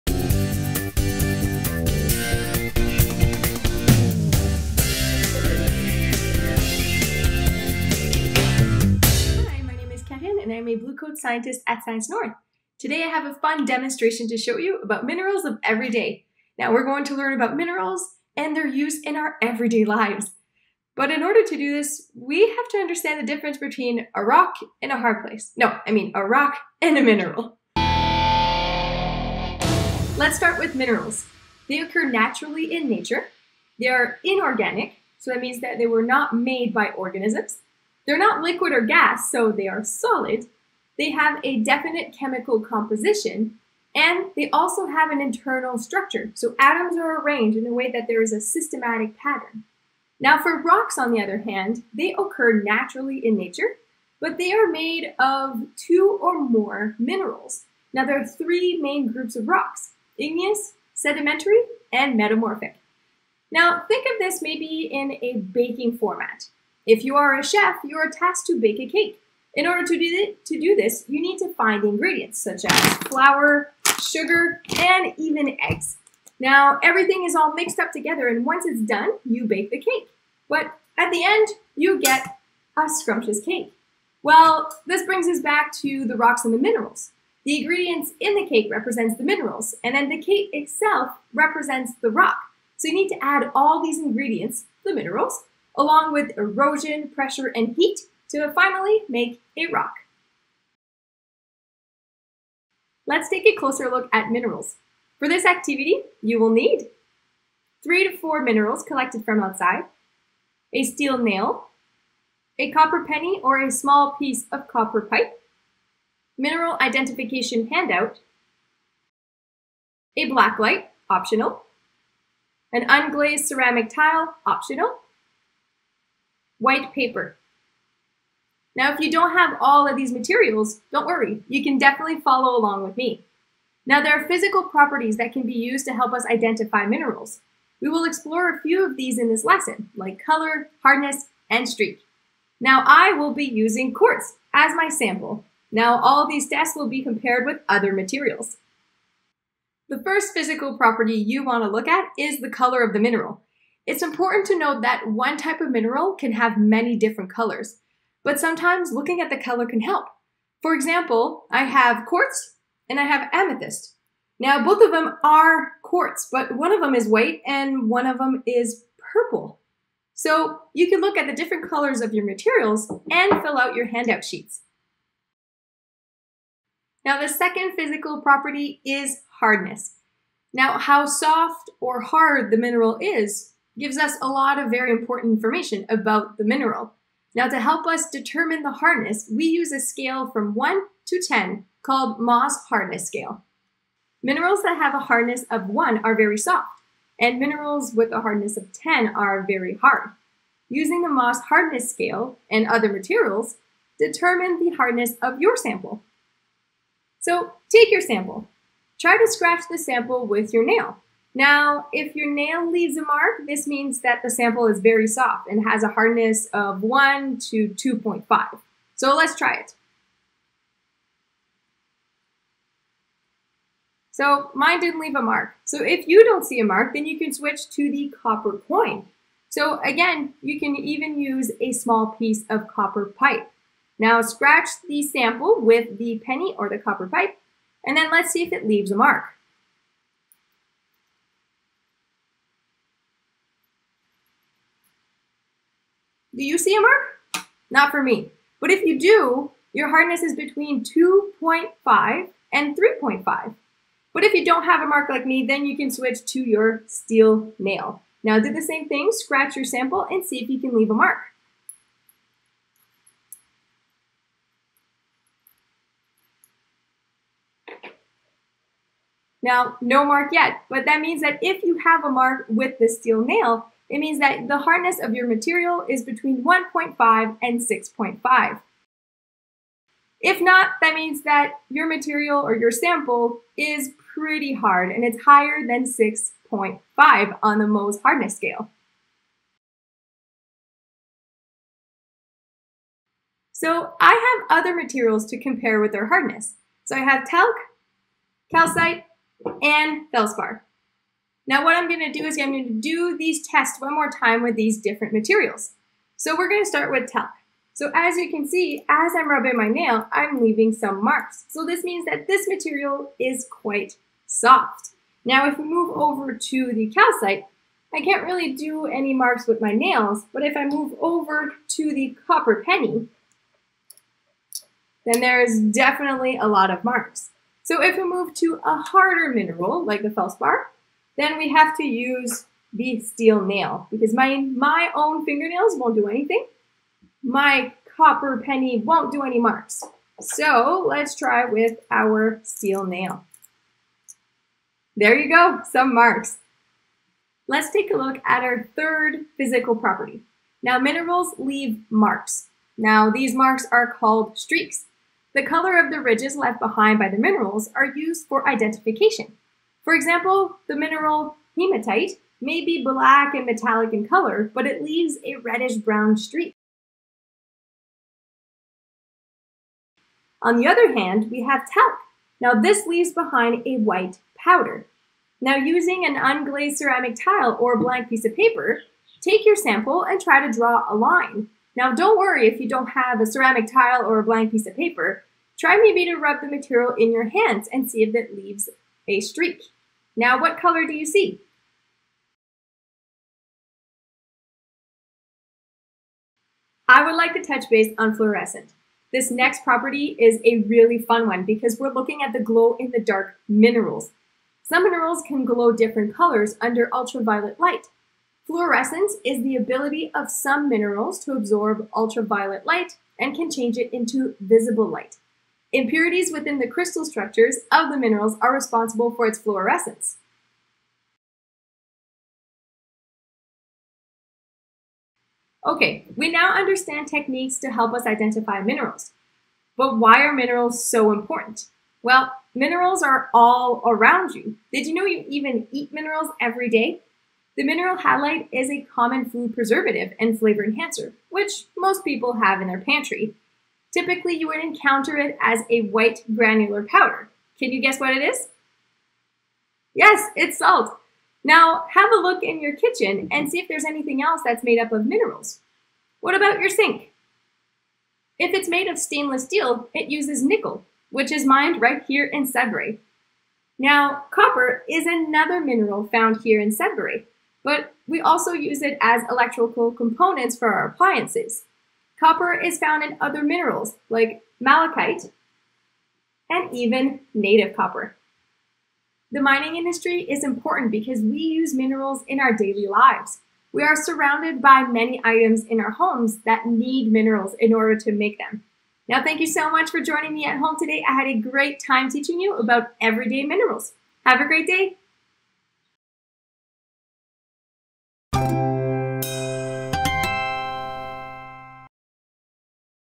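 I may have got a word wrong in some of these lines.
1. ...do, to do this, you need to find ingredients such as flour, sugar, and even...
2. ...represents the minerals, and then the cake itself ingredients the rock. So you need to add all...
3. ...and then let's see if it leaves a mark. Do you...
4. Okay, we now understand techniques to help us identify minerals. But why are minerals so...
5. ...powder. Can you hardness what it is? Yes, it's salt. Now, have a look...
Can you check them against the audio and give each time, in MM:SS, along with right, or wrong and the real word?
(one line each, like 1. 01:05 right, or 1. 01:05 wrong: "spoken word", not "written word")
1. 01:09 right
2. 01:28 wrong: "represents", not "ingredients"
3. 03:57 right
4. 07:05 right
5. 07:26 wrong: "guess", not "hardness".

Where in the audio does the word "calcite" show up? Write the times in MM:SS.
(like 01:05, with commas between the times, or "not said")
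04:58, 05:16.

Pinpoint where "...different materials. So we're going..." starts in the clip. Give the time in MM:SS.
05:04.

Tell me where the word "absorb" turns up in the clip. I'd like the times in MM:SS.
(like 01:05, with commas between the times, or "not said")
06:51.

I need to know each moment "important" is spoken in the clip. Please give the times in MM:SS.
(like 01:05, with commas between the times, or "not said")
02:34, 03:04, 07:11, 08:00.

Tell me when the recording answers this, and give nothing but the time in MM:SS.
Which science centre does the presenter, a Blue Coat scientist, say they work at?
00:11.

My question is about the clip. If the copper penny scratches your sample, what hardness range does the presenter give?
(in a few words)
2.5 to 3.5.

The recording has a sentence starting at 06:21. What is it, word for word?
Now don't worry if you don't have a ceramic tile or a blank piece of paper.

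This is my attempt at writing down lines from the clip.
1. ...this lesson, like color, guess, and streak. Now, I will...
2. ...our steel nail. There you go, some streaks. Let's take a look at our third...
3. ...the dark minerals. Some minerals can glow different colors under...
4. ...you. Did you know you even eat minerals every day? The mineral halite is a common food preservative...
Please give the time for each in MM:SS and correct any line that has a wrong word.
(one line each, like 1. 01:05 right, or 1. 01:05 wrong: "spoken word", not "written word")
1. 02:19 wrong: "hardness", not "guess"
2. 05:41 wrong: "marks", not "streaks"
3. 06:42 right
4. 07:14 right.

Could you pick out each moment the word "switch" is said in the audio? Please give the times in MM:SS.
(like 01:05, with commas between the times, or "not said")
03:47, 04:15.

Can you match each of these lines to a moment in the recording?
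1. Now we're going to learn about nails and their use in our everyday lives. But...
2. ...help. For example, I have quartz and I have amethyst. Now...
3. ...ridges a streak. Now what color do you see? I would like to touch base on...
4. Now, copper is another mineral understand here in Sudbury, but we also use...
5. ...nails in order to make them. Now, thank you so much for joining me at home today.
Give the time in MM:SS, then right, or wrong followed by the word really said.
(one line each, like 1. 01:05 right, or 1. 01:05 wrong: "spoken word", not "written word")
1. 00:16 wrong: "minerals", not "nails"
2. 02:39 right
3. 06:28 wrong: "leaves", not "ridges"
4. 07:43 wrong: "found", not "understand"
5. 08:07 wrong: "minerals", not "nails".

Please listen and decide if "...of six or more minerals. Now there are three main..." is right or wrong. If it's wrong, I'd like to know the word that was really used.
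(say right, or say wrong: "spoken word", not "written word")
wrong: "two", not "six".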